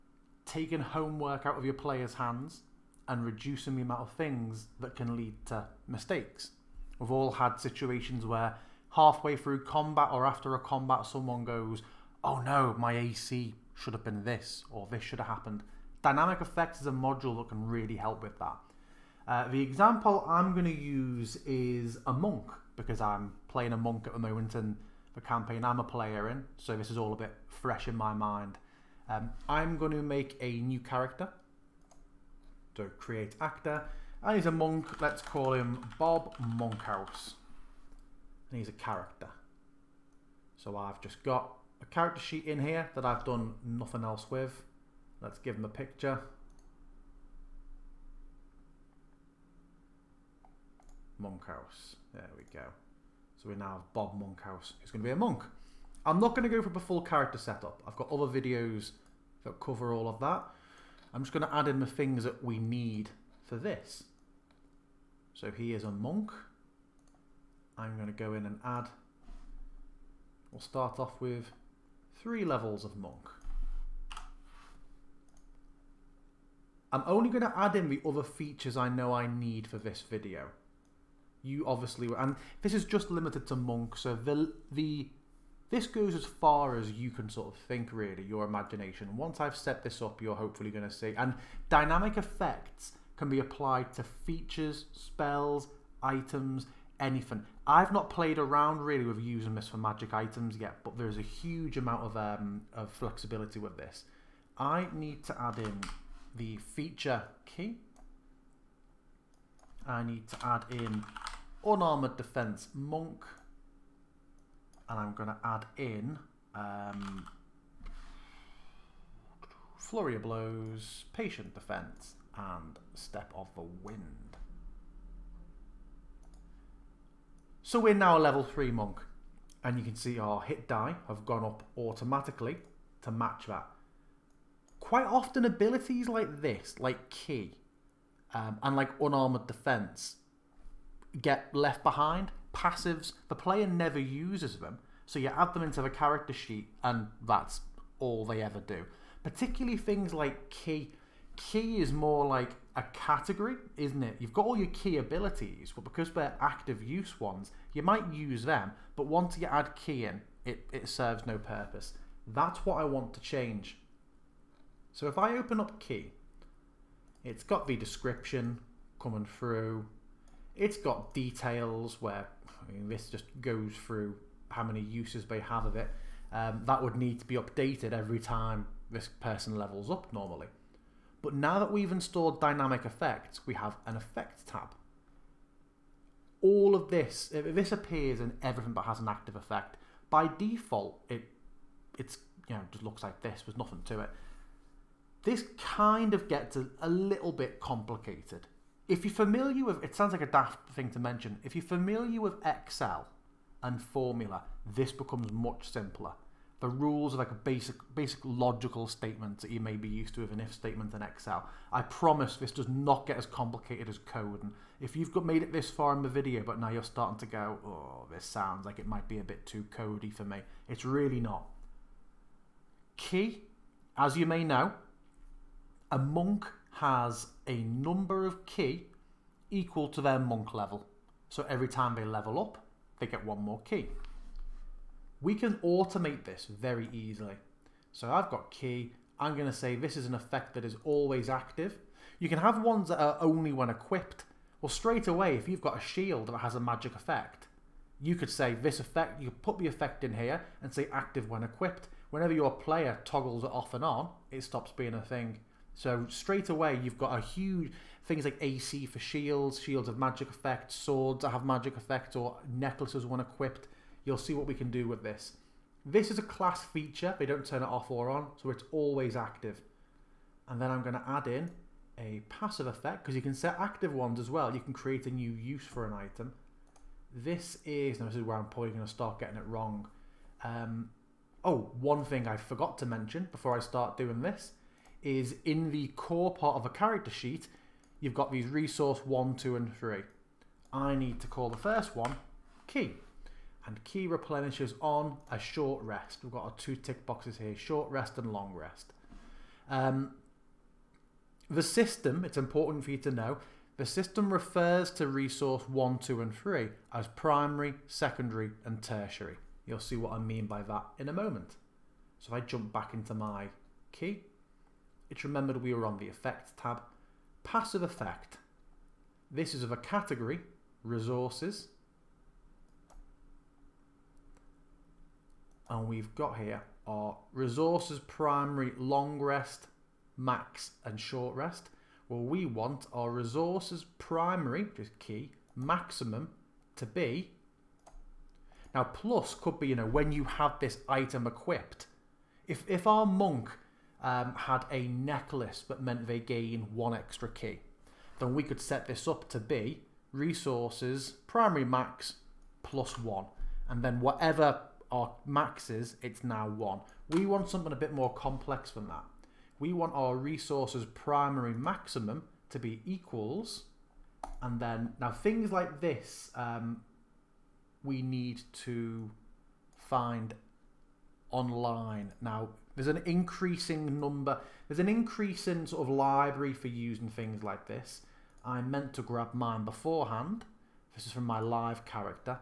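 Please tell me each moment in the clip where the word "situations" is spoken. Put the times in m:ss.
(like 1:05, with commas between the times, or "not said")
0:07.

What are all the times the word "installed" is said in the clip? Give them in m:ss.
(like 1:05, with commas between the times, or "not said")
3:01.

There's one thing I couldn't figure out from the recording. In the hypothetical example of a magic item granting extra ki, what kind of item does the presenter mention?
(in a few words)
necklace.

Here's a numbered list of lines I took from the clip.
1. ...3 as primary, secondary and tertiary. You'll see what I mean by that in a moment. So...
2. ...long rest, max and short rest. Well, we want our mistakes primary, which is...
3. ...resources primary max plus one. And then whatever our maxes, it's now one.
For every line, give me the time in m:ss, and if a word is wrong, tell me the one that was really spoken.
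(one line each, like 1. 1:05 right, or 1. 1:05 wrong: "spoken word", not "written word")
1. 5:06 right
2. 5:28 wrong: "resources", not "mistakes"
3. 5:50 right.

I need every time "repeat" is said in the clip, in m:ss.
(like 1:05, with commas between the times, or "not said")
not said.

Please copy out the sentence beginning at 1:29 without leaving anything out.
Once I've set this up, you're hopefully going to see, and dynamic effects can be applied to features, spells, items, anything.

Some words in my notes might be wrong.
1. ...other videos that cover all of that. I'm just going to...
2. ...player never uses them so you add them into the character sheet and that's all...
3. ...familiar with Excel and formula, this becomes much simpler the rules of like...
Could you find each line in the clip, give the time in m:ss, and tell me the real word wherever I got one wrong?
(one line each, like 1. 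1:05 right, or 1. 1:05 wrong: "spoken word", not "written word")
1. 0:58 right
2. 2:23 right
3. 3:21 right.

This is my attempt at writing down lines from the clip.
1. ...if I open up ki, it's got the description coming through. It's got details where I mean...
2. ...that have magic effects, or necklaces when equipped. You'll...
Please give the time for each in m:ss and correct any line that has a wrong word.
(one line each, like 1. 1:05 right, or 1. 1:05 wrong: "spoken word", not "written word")
1. 2:45 right
2. 4:21 right.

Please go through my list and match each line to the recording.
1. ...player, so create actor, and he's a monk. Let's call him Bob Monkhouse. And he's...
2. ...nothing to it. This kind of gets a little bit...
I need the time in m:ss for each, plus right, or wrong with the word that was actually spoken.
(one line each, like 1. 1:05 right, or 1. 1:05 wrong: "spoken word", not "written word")
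1. 0:30 wrong: "character", not "player"
2. 3:13 right.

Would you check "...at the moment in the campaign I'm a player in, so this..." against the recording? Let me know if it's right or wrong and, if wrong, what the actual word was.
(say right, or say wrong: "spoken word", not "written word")
right.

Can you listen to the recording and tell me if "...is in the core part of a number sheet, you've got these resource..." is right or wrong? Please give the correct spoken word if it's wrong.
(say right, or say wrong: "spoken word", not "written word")
wrong: "character", not "number".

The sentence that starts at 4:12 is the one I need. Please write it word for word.
Whenever your player toggles it off and on, it stops being a thing.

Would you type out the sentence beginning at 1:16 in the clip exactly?
I'm only going to add in the other features I know I need for this video.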